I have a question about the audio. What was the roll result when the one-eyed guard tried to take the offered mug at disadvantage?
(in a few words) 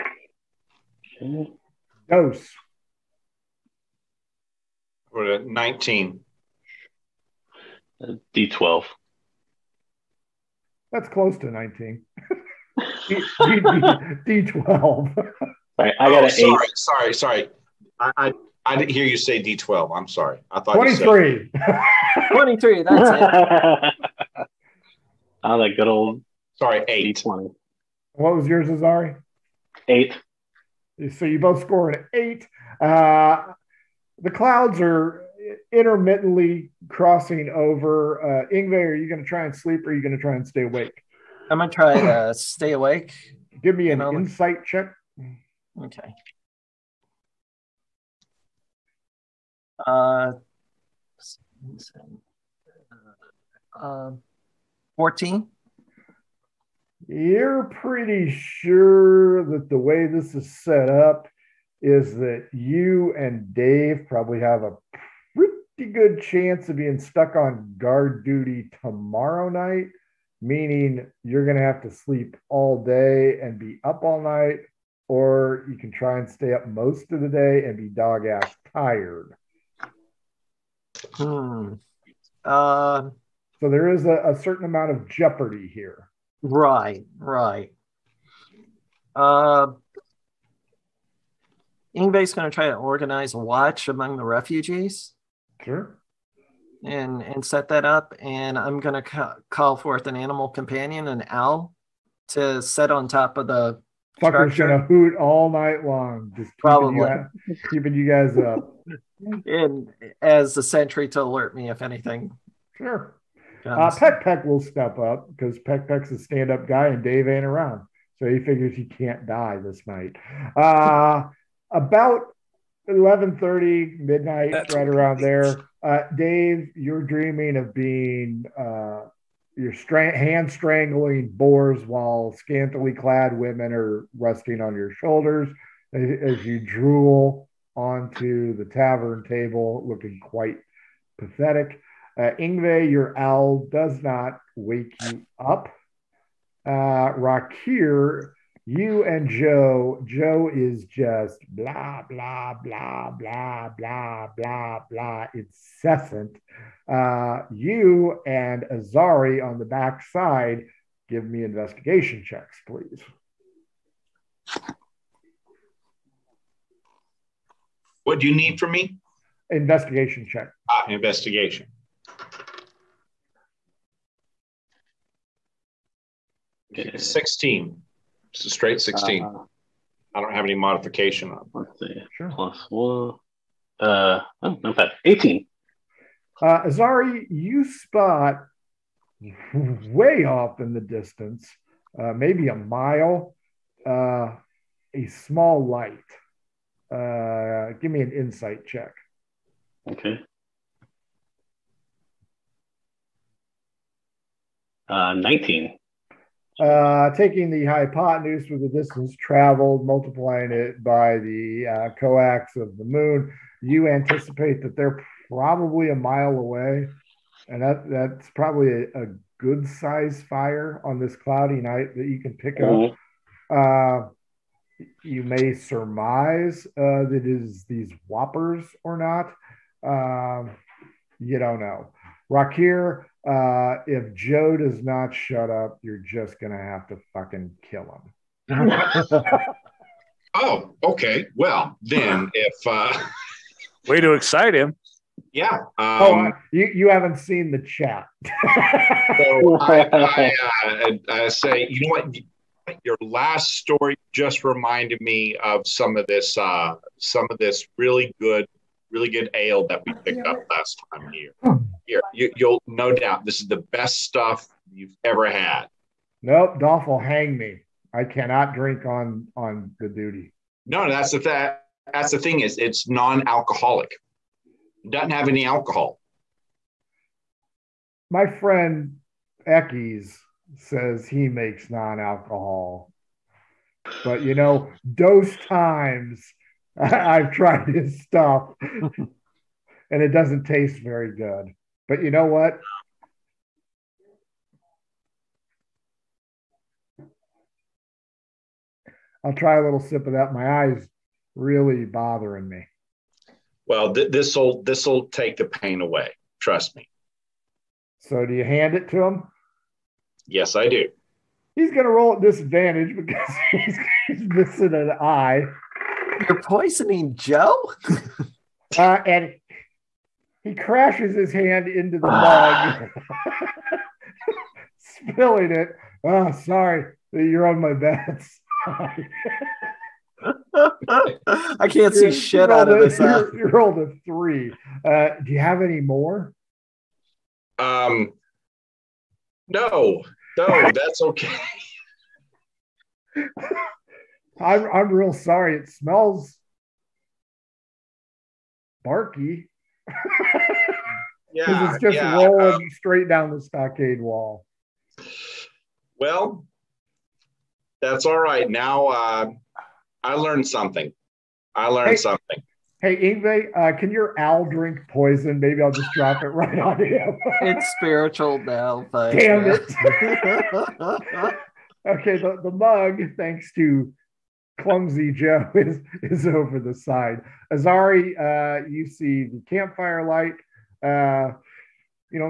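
3.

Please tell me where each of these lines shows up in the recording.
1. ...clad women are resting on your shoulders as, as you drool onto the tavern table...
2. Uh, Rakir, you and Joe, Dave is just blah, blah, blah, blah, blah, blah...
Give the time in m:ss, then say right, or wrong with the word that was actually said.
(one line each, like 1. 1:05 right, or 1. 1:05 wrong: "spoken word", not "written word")
1. 2:12 right
2. 2:26 wrong: "Joe", not "Dave".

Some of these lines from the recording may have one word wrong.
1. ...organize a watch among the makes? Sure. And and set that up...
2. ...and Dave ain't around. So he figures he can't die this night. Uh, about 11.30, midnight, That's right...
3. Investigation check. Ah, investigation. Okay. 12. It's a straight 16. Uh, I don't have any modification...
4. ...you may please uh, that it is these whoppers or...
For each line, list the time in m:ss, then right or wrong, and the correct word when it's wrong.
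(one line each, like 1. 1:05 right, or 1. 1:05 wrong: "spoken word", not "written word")
1. 1:32 wrong: "refugees", not "makes"
2. 1:56 right
3. 2:49 wrong: "16", not "12"
4. 3:45 wrong: "surmise", not "please".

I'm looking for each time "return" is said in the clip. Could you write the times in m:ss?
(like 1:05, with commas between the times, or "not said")
not said.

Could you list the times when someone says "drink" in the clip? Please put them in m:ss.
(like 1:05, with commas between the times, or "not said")
4:28, 6:04.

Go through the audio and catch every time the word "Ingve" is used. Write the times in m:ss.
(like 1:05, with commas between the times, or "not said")
0:38, 2:22, 6:02.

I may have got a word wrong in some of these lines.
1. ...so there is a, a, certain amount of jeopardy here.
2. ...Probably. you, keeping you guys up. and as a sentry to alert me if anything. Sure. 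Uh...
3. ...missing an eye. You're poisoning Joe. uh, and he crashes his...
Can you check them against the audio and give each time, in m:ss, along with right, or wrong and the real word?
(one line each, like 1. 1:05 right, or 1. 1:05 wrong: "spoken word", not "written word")
1. 1:23 right
2. 1:46 right
3. 5:14 right.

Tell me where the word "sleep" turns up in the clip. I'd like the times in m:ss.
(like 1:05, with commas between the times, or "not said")
0:39, 1:11.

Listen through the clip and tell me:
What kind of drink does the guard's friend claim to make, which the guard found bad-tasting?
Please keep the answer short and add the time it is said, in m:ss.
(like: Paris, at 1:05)
non-alcohol, at 4:41.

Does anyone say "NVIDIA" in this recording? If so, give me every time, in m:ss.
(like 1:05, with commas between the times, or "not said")
not said.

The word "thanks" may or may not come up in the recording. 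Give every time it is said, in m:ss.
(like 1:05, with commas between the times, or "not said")
6:08, 6:13.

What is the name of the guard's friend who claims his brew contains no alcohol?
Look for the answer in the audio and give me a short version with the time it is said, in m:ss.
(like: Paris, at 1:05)
Eckes, at 4:38.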